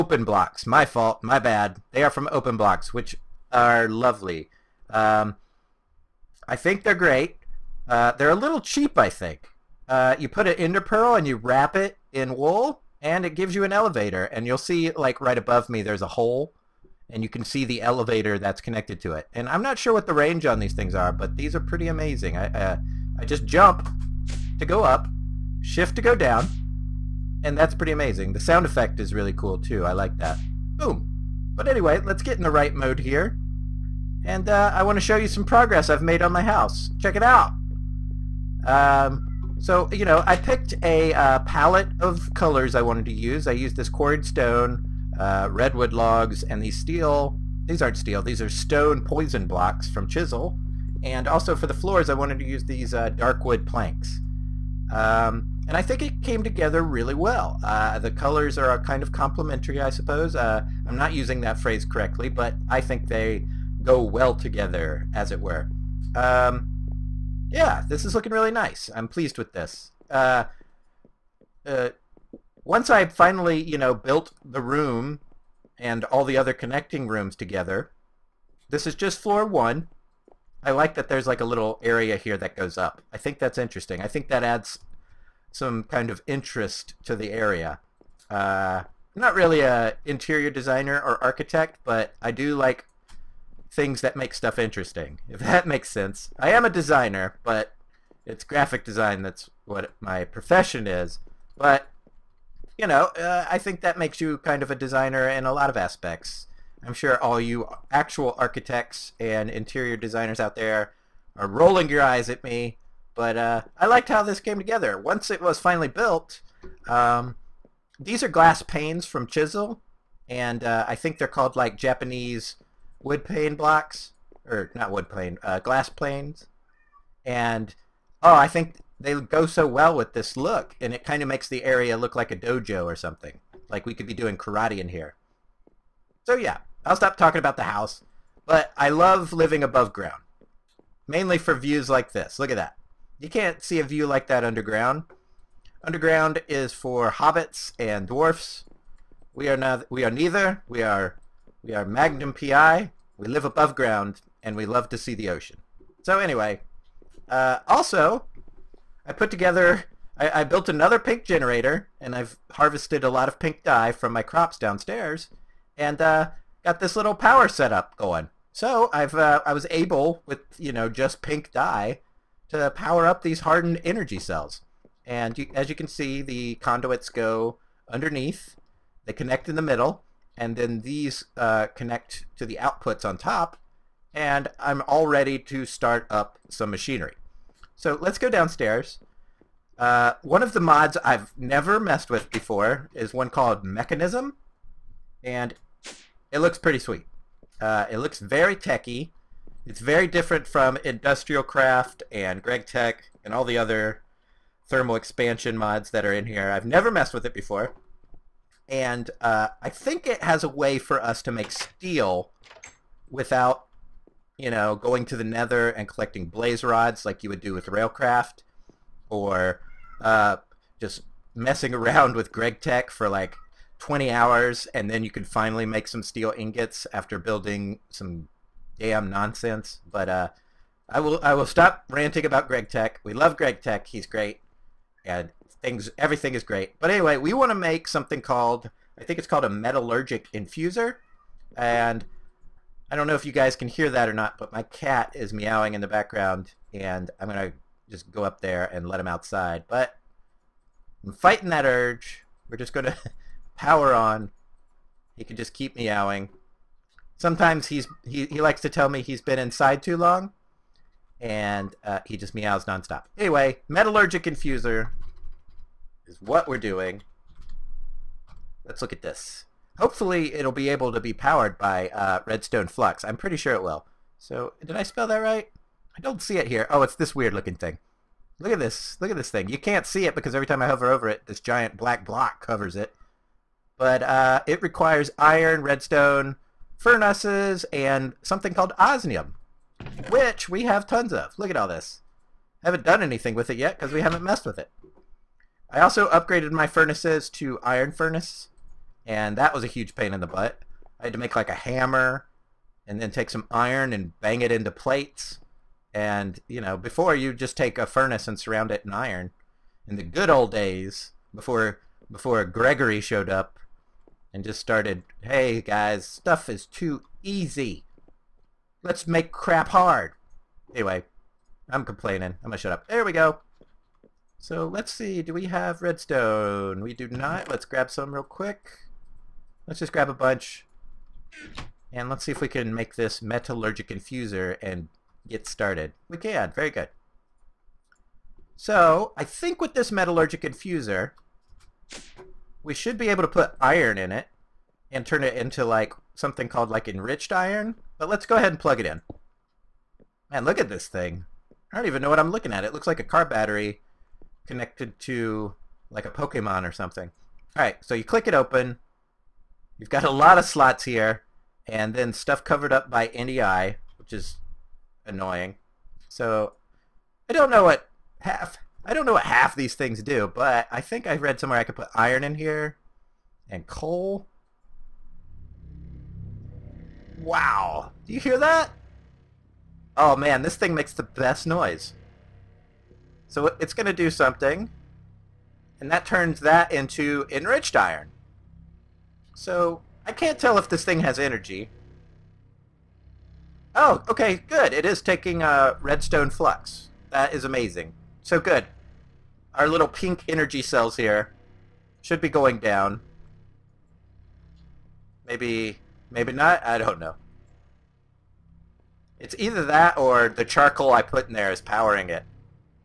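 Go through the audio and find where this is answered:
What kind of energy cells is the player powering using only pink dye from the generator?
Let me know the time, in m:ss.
2:53.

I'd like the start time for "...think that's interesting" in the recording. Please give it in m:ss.
1:23.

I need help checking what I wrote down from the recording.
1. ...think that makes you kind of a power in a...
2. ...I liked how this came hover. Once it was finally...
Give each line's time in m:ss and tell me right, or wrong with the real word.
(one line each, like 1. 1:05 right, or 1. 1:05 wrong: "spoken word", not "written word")
1. 1:43 wrong: "designer", not "power"
2. 1:53 wrong: "together", not "hover".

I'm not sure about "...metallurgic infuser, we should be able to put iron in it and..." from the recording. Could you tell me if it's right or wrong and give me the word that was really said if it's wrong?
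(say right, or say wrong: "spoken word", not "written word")
right.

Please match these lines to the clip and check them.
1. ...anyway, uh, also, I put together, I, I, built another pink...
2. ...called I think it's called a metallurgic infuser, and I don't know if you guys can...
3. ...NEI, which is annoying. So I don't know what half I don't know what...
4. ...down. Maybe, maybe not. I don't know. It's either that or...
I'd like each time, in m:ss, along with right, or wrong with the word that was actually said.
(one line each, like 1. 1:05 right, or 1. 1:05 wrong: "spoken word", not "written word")
1. 2:36 right
2. 3:58 right
3. 6:03 right
4. 6:42 right.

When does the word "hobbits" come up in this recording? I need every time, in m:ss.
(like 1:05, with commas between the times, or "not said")
2:27.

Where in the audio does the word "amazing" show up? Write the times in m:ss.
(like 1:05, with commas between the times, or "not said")
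0:21, 0:27, 6:37.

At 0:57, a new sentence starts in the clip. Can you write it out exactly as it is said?
Uh, the colors are kind of complementary, I suppose.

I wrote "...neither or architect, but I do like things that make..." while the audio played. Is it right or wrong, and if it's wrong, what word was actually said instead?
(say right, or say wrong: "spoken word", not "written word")
wrong: "designer", not "neither".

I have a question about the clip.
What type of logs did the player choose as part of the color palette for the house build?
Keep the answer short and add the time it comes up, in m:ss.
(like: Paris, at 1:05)
Redwood logs, at 0:45.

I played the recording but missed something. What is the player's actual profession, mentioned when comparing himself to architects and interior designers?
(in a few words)
Graphic design.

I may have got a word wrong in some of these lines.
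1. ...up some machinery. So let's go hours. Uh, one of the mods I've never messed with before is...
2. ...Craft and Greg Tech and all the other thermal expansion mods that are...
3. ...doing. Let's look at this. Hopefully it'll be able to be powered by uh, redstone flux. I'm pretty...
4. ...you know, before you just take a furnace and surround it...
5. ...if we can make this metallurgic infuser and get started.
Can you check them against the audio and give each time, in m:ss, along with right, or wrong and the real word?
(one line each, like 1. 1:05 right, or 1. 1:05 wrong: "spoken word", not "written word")
1. 3:06 wrong: "downstairs", not "hours"
2. 3:21 right
3. 4:26 right
4. 5:06 right
5. 5:32 right.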